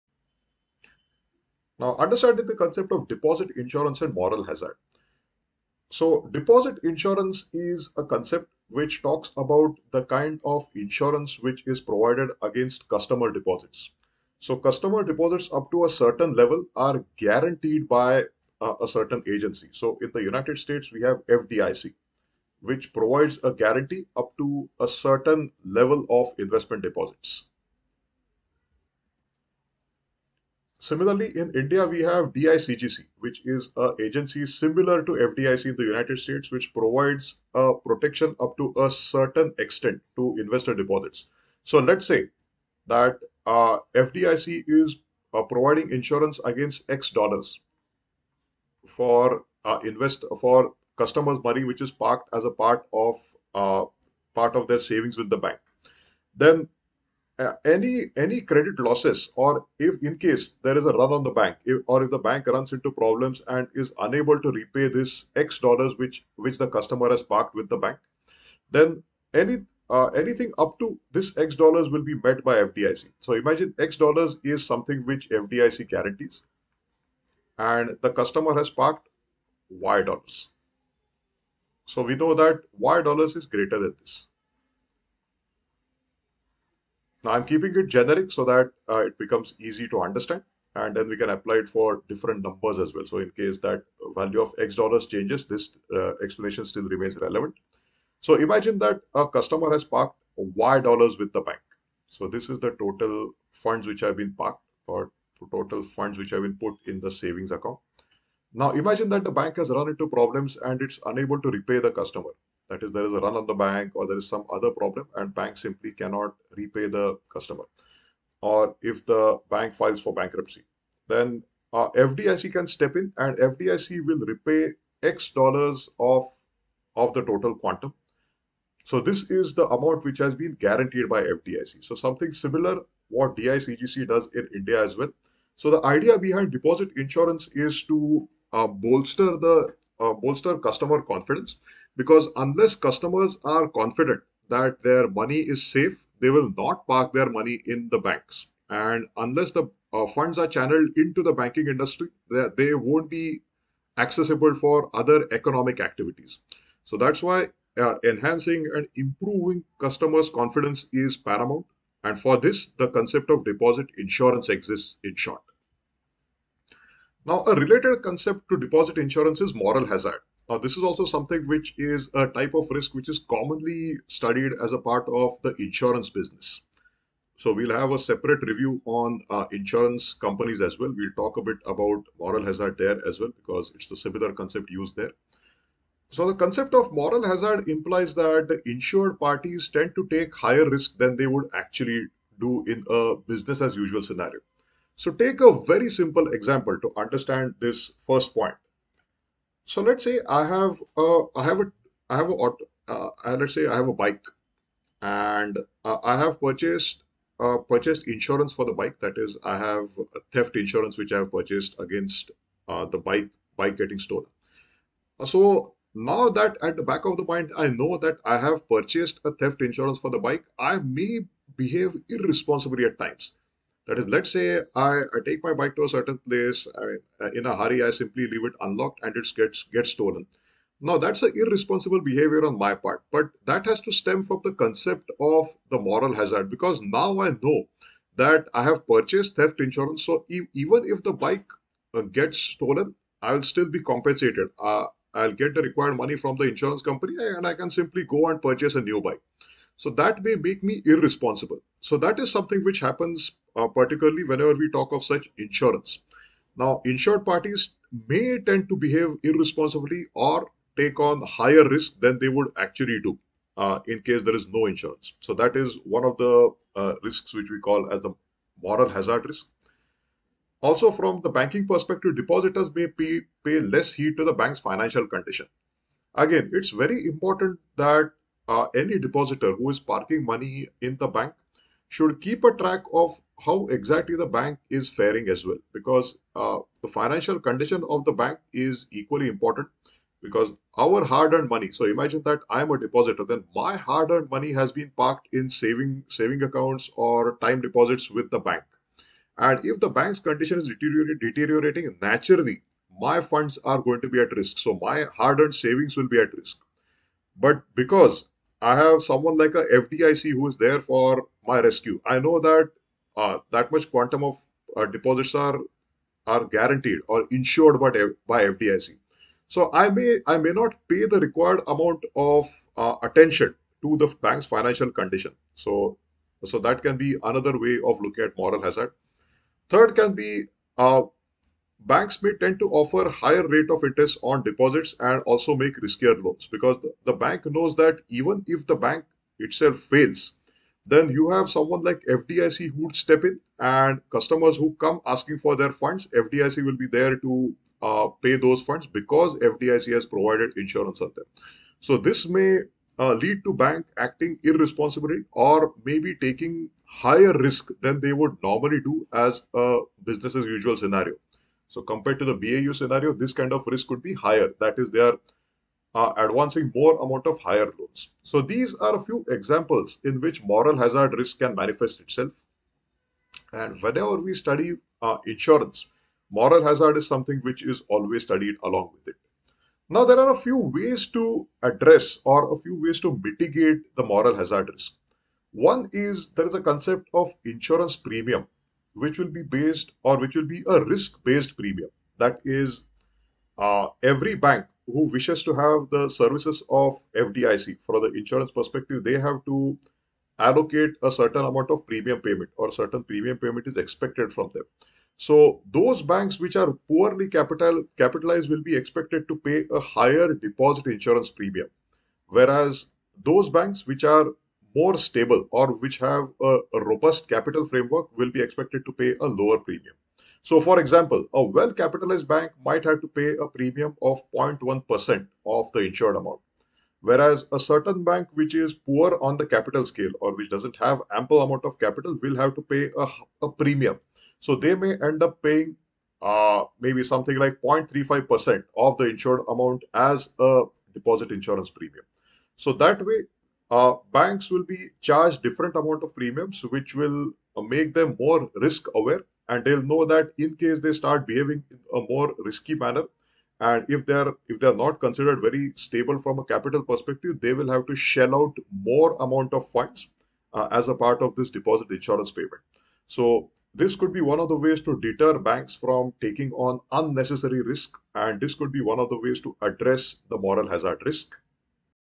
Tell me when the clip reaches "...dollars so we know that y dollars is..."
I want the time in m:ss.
1:20.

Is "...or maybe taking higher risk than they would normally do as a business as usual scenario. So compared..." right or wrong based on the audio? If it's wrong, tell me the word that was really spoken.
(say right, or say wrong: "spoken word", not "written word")
right.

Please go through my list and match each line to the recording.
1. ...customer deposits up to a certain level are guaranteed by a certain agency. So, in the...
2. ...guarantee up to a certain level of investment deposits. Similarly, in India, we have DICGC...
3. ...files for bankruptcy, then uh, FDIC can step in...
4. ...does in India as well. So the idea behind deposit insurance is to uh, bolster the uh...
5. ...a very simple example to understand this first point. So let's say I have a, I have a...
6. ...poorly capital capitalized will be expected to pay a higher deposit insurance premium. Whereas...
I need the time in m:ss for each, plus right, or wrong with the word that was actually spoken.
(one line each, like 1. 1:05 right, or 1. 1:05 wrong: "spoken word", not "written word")
1. 0:14 right
2. 0:23 right
3. 1:59 right
4. 2:14 right
5. 3:15 right
6. 6:46 right.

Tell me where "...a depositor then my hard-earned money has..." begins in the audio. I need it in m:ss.
4:52.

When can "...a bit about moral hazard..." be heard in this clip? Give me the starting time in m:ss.
3:01.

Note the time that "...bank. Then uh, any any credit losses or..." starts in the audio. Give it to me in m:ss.
0:55.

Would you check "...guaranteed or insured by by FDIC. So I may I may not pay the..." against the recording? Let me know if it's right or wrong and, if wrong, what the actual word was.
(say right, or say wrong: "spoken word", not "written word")
right.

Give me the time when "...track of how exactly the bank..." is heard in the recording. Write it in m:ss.
4:42.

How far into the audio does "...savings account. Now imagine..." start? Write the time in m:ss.
1:47.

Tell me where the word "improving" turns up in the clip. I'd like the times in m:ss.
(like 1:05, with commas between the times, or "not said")
2:38.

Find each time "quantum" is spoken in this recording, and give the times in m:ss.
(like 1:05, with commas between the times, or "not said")
2:07, 5:13.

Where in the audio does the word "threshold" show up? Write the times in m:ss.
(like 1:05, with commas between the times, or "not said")
not said.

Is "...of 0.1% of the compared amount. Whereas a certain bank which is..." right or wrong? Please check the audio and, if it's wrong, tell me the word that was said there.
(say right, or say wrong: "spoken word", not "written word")
wrong: "insured", not "compared".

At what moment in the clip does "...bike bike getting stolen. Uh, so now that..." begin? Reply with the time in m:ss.
3:32.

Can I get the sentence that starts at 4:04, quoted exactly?
Uh, I'll get the required money from the insurance company and I can simply go and purchase a new bike.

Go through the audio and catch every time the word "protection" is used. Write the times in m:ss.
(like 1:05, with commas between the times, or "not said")
0:37.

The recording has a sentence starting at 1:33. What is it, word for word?
So in case that value of X dollars changes, this uh, explanation still remains relevant.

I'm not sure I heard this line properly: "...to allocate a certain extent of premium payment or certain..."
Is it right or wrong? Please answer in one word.
wrong.